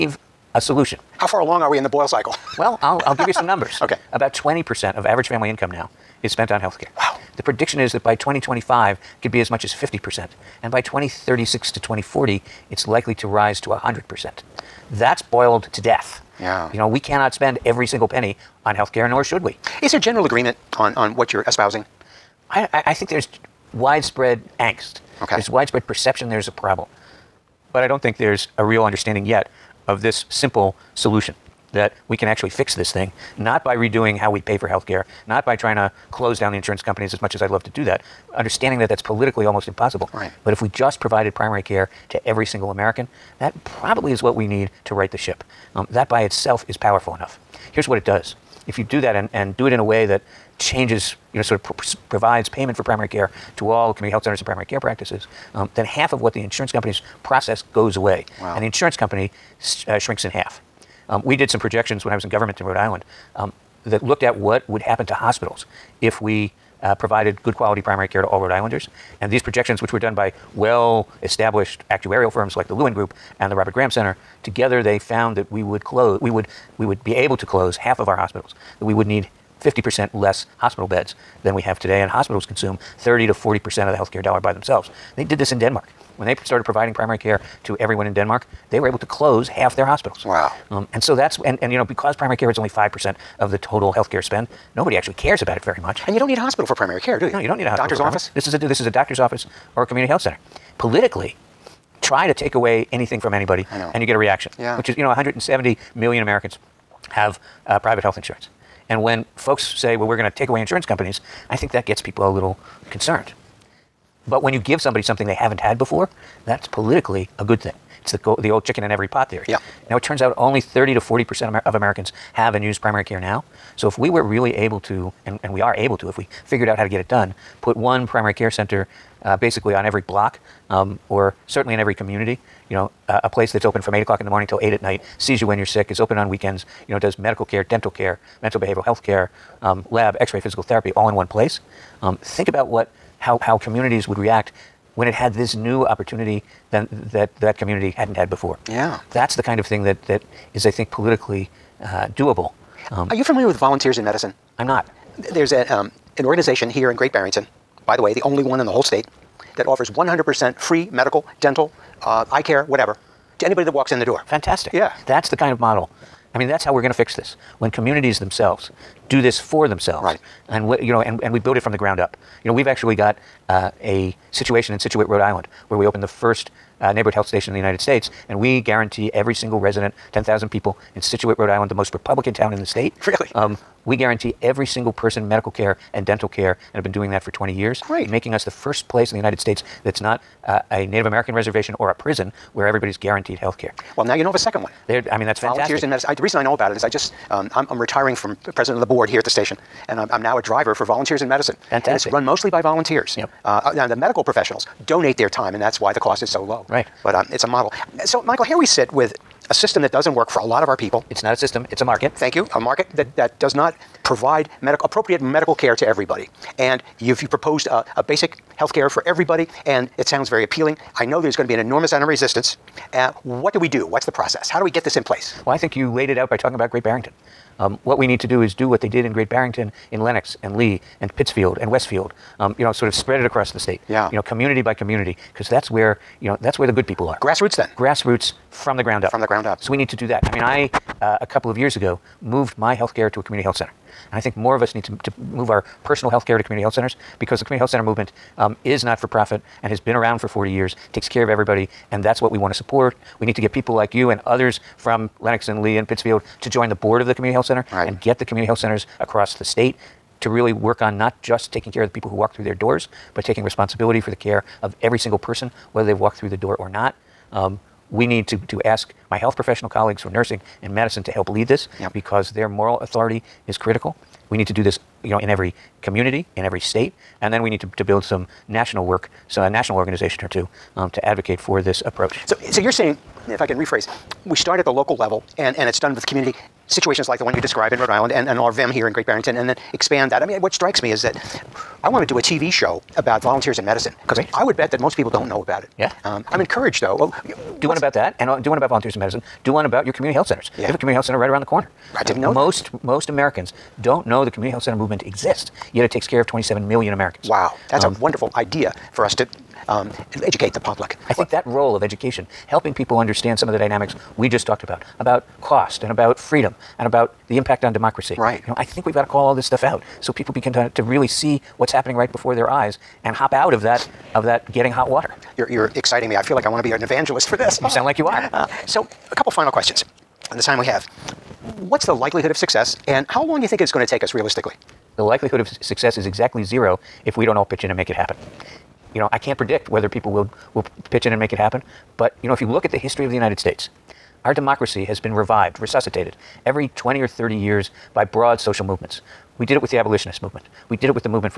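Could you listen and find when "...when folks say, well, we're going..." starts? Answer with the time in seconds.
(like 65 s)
109 s.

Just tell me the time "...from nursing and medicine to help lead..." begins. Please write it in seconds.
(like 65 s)
270 s.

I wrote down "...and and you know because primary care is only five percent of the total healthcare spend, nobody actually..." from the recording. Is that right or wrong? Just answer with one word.
right.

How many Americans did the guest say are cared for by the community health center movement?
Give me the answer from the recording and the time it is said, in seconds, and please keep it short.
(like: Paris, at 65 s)
27 million, at 306 s.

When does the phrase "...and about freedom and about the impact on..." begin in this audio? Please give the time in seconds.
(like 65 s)
315 s.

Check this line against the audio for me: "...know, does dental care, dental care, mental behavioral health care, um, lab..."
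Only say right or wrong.
wrong.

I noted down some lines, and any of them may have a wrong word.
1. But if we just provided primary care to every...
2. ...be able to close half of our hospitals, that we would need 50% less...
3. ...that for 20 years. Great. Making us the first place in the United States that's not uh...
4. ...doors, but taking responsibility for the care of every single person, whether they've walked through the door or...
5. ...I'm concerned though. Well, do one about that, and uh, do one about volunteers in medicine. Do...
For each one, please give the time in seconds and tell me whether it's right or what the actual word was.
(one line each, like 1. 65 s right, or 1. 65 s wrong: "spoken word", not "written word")
1. 40 s right
2. 77 s right
3. 187 s right
4. 262 s right
5. 296 s wrong: "encouraged", not "concerned".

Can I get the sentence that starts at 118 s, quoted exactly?
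It's the, the old chicken in every pot theory.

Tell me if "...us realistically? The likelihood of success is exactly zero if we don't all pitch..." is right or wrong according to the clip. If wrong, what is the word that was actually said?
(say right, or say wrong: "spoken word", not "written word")
right.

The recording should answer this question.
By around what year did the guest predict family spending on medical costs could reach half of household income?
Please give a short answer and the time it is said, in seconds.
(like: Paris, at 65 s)
2025, at 8 s.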